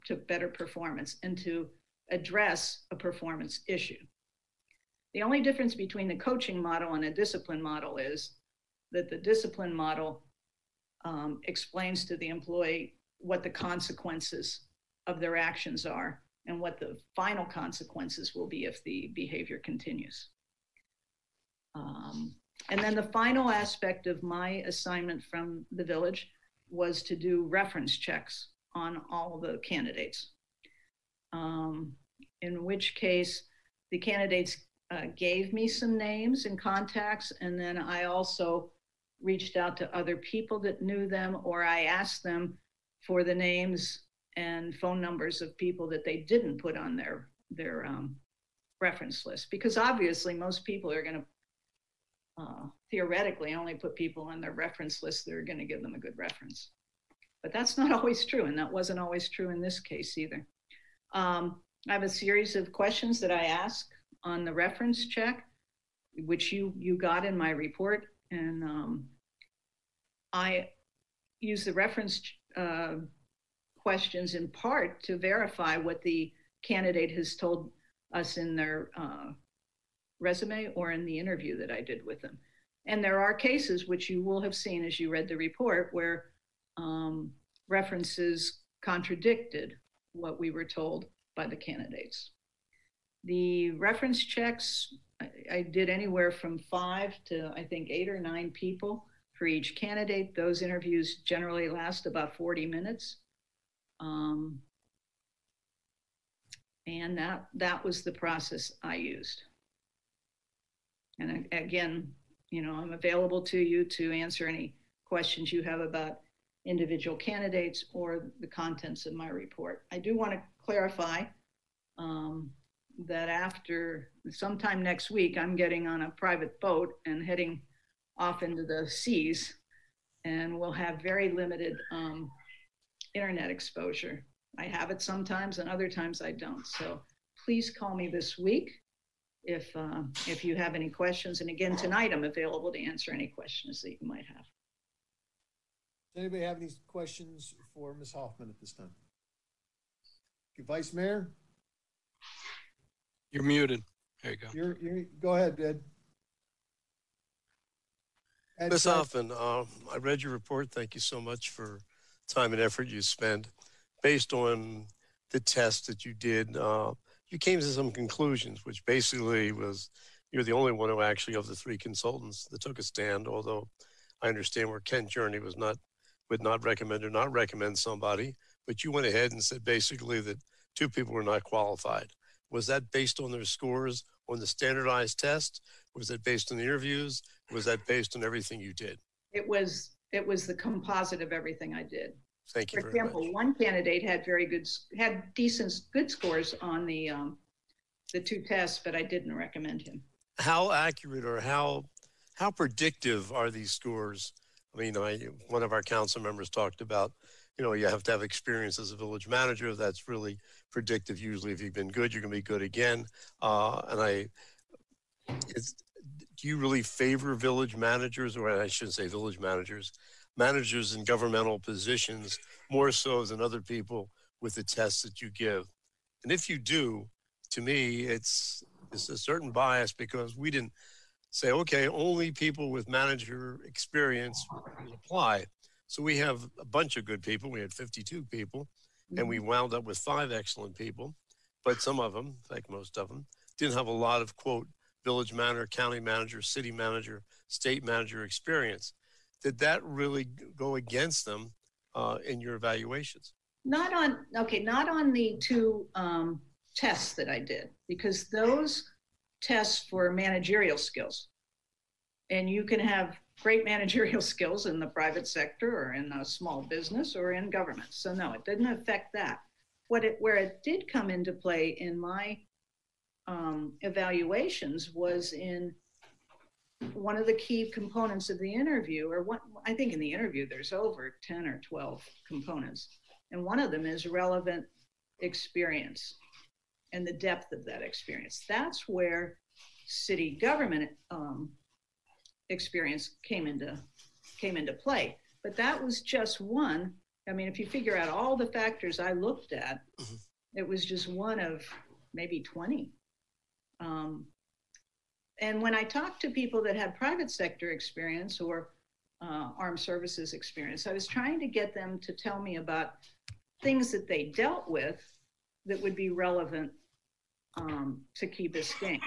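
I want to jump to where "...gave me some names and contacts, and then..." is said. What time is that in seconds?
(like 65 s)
35 s.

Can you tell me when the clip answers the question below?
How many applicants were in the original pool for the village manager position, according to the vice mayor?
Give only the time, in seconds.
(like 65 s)
237 s.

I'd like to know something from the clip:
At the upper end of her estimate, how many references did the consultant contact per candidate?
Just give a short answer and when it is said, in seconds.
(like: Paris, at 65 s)
9, at 98 s.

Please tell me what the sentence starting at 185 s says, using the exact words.
Was it based on the interviews?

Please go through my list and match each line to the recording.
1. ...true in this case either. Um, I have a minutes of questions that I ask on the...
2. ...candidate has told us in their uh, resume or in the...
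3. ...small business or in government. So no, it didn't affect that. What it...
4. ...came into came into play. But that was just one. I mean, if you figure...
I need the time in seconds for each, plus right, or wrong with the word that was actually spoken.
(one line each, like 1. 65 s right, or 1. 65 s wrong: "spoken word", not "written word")
1. 59 s wrong: "series", not "minutes"
2. 76 s right
3. 266 s right
4. 293 s right.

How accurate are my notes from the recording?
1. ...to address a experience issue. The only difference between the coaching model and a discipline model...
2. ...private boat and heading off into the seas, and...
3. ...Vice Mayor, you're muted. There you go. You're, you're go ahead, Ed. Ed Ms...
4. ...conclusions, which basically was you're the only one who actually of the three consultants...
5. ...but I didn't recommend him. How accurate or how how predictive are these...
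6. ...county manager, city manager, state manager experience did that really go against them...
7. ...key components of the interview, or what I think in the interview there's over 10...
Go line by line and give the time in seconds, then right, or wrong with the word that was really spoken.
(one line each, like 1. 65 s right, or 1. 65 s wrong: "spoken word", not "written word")
1. 1 s wrong: "performance", not "experience"
2. 126 s right
3. 150 s right
4. 167 s right
5. 198 s right
6. 245 s right
7. 277 s right.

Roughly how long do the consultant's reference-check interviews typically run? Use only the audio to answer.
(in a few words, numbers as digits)
40 minutes.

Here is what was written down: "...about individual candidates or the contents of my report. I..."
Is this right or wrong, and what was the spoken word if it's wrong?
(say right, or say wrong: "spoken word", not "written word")
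right.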